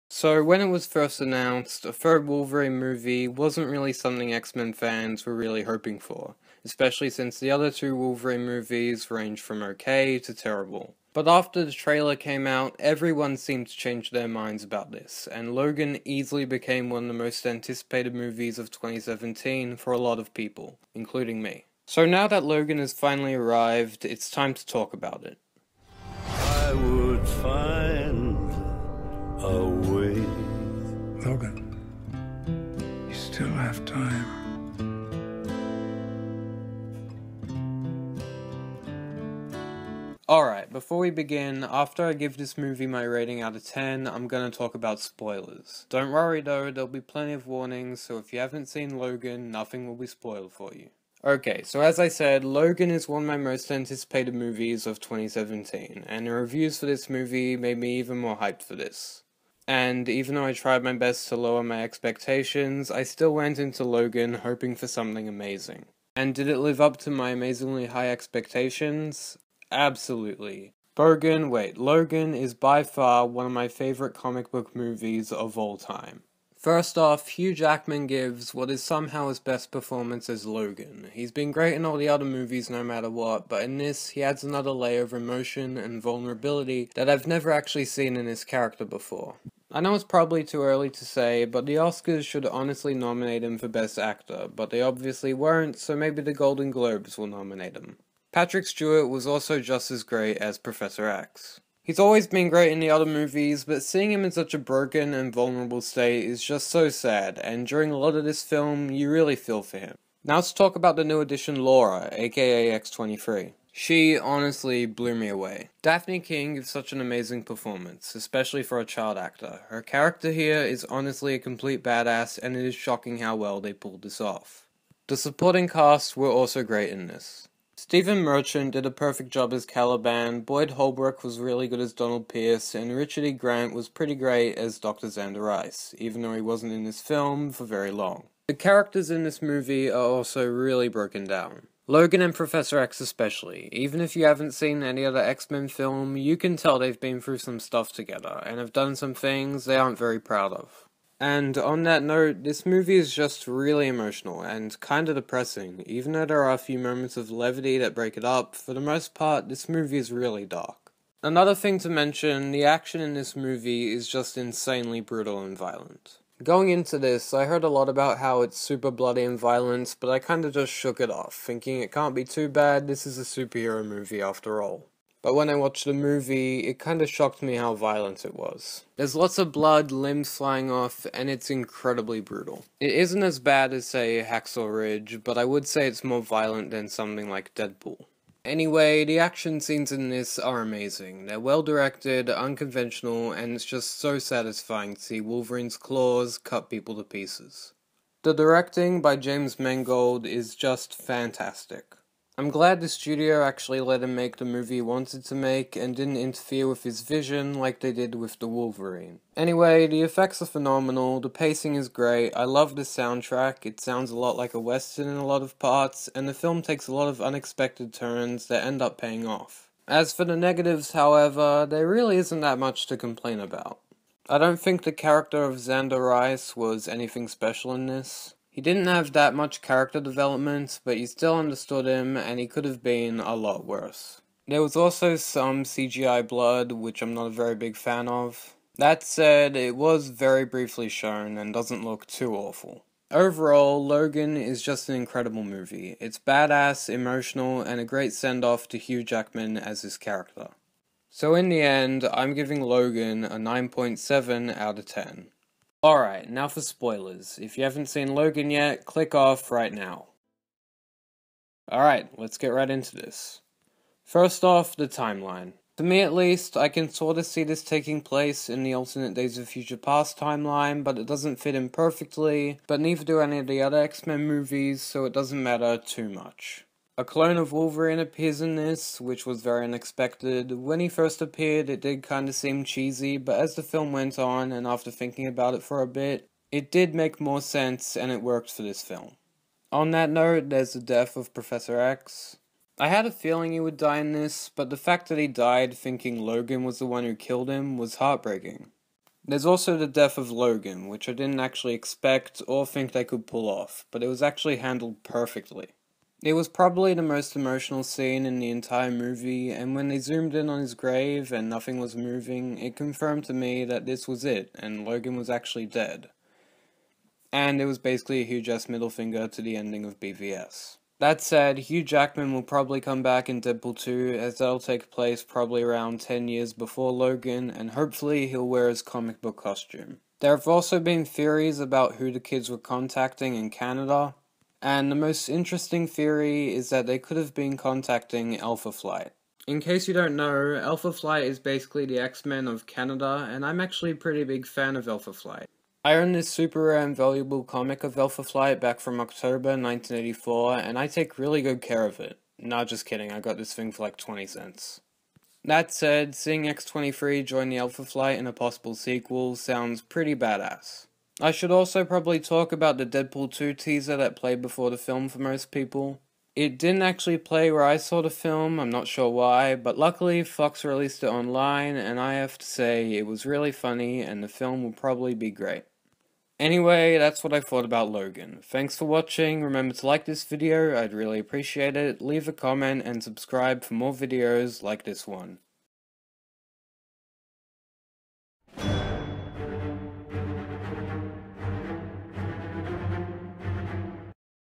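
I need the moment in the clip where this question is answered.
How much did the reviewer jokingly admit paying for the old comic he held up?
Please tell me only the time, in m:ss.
5:53.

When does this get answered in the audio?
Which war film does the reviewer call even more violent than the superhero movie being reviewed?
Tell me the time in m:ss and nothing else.
3:04.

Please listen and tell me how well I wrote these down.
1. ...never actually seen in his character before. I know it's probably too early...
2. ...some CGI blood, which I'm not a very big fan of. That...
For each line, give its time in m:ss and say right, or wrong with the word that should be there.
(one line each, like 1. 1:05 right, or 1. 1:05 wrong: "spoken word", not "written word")
1. 1:27 right
2. 3:55 right.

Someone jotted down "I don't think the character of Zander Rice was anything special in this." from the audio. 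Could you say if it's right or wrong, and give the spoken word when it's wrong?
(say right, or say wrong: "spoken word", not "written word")
right.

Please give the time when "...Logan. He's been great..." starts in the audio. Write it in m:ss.
1:20.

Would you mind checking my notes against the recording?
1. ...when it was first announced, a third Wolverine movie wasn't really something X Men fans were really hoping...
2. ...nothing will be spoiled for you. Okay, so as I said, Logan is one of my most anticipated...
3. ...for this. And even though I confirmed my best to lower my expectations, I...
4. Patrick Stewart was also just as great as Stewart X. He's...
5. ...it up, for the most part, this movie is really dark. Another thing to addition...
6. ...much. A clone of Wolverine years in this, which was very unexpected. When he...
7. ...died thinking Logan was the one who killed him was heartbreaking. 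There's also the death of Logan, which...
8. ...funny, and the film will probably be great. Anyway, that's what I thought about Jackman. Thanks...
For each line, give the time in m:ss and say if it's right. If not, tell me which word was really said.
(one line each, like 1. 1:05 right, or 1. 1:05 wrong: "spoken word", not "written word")
1. 0:00 right
2. 0:49 right
3. 0:58 wrong: "tried", not "confirmed"
4. 1:38 wrong: "Professor", not "Stewart"
5. 2:38 wrong: "mention", not "addition"
6. 4:36 wrong: "appears", not "years"
7. 4:55 right
8. 6:13 wrong: "Logan", not "Jackman".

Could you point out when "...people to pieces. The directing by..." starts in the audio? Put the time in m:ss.
3:16.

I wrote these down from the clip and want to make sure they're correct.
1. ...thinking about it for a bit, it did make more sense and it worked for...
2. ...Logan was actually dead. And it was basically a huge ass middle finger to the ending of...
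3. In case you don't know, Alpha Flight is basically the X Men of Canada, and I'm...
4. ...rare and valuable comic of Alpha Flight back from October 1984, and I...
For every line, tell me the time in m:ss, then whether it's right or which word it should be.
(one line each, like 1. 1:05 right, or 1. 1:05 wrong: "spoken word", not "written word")
1. 4:44 right
2. 5:14 right
3. 5:39 right
4. 5:46 right.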